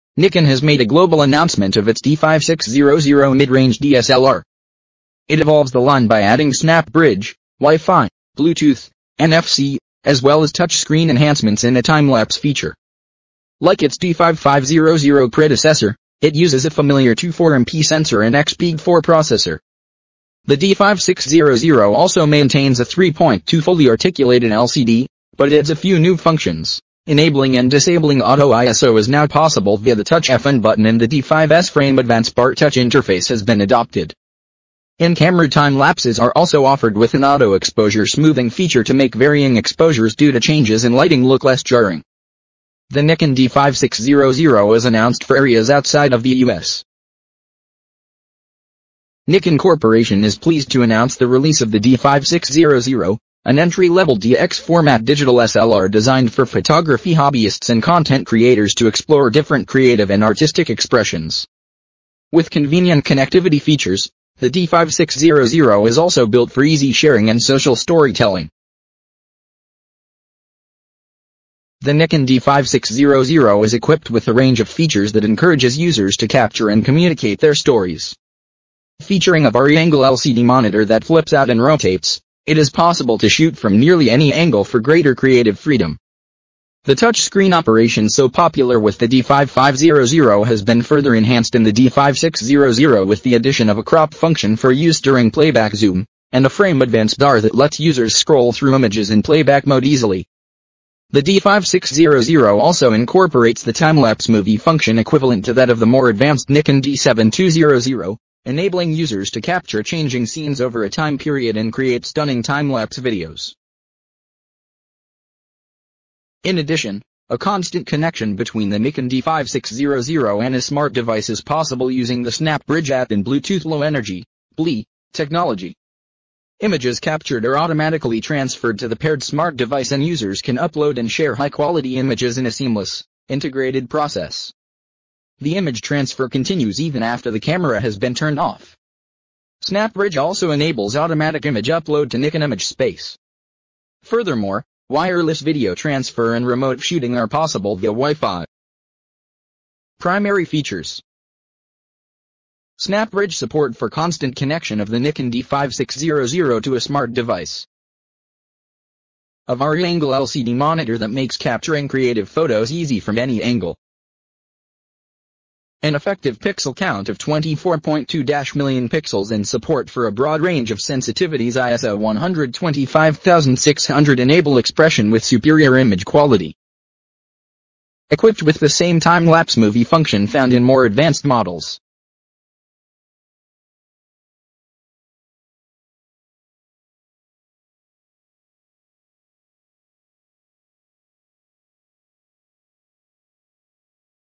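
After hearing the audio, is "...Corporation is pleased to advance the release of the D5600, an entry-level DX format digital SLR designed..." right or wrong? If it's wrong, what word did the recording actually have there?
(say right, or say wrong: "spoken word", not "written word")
wrong: "announce", not "advance".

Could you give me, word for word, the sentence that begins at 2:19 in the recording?
SnapBridge also enables automatic image upload to Nikon image space.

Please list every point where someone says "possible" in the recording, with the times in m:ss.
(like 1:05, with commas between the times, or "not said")
0:29, 1:22, 2:01, 2:27.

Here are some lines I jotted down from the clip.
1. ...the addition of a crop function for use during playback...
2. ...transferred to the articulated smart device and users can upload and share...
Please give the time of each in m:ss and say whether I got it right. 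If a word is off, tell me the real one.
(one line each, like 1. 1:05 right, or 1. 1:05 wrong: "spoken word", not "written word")
1. 1:33 right
2. 2:08 wrong: "paired", not "articulated".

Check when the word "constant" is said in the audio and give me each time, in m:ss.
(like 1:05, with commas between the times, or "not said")
1:57, 2:33.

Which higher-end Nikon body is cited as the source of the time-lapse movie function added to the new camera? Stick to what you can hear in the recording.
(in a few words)
Nikon D7200.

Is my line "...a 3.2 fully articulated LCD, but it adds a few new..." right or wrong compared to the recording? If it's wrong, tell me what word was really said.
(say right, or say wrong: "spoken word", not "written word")
right.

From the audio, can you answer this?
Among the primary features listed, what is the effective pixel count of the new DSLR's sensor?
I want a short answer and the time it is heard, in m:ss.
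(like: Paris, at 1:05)
24.2 million pixels, at 2:47.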